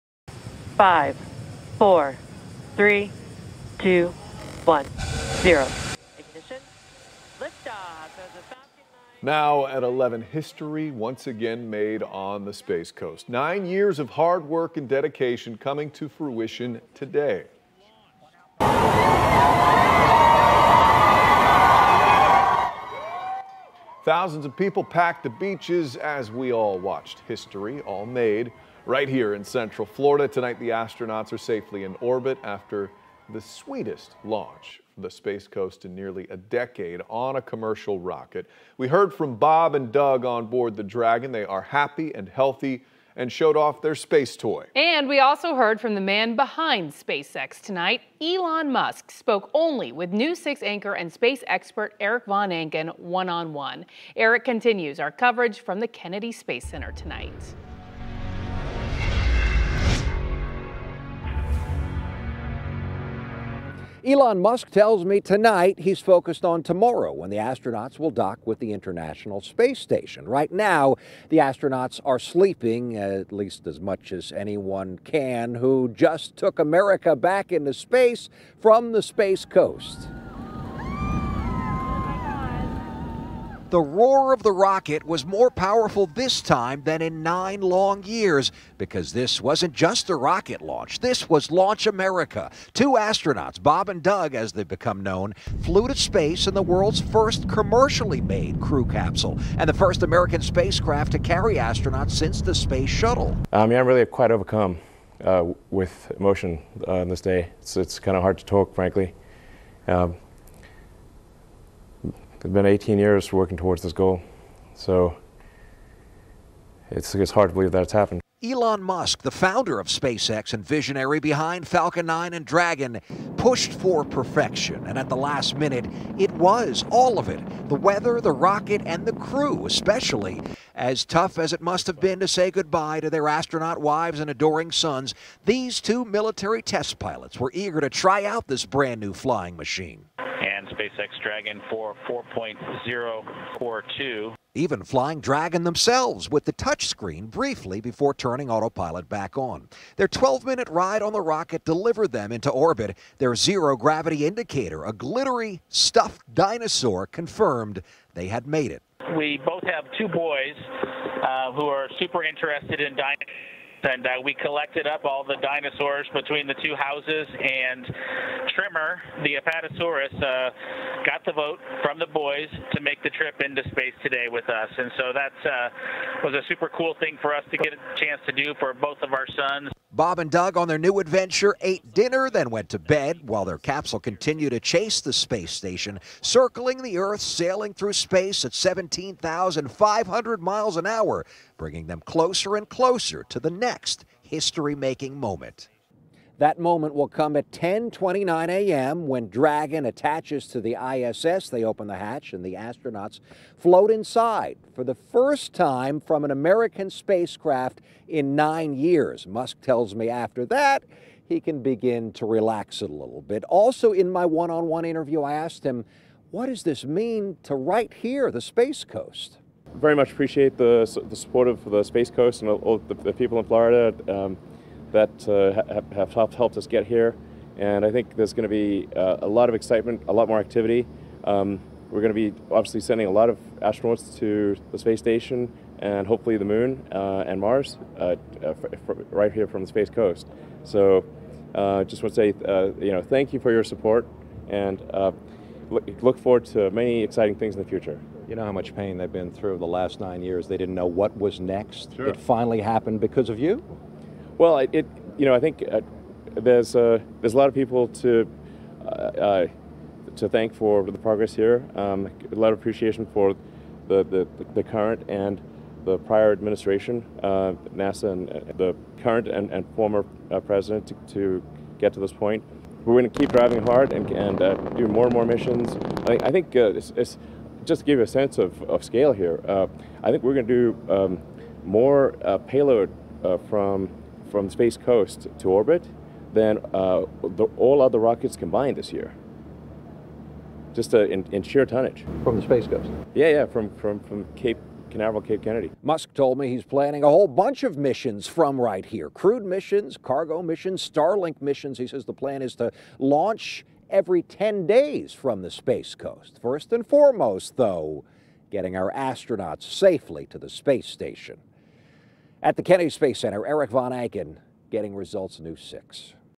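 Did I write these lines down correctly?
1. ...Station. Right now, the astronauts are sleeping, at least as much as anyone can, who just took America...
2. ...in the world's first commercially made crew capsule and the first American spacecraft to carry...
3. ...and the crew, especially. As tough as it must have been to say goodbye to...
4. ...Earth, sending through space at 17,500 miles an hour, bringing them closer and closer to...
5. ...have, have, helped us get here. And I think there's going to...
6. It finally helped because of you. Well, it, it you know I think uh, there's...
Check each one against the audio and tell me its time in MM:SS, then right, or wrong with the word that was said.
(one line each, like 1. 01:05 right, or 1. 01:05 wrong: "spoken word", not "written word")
1. 01:09 right
2. 01:36 right
3. 02:08 right
4. 03:06 wrong: "sailing", not "sending"
5. 03:45 right
6. 04:12 wrong: "happened", not "helped".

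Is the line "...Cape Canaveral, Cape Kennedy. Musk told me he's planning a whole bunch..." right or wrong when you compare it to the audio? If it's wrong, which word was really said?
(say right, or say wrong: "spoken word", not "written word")
right.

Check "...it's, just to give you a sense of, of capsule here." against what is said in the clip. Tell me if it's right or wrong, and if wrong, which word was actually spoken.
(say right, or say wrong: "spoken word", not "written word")
wrong: "scale", not "capsule".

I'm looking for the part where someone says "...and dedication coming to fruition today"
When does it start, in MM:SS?
00:14.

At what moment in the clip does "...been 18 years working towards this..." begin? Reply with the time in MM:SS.
01:52.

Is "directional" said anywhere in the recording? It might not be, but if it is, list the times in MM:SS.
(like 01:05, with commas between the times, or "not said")
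not said.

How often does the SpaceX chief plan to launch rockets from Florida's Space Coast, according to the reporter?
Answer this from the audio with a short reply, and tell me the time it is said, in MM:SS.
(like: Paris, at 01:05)
every 10 days, at 05:03.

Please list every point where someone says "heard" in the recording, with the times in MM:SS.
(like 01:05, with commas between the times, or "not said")
00:38, 00:45.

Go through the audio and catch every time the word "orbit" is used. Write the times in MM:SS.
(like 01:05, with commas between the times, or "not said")
00:32, 02:32, 04:45.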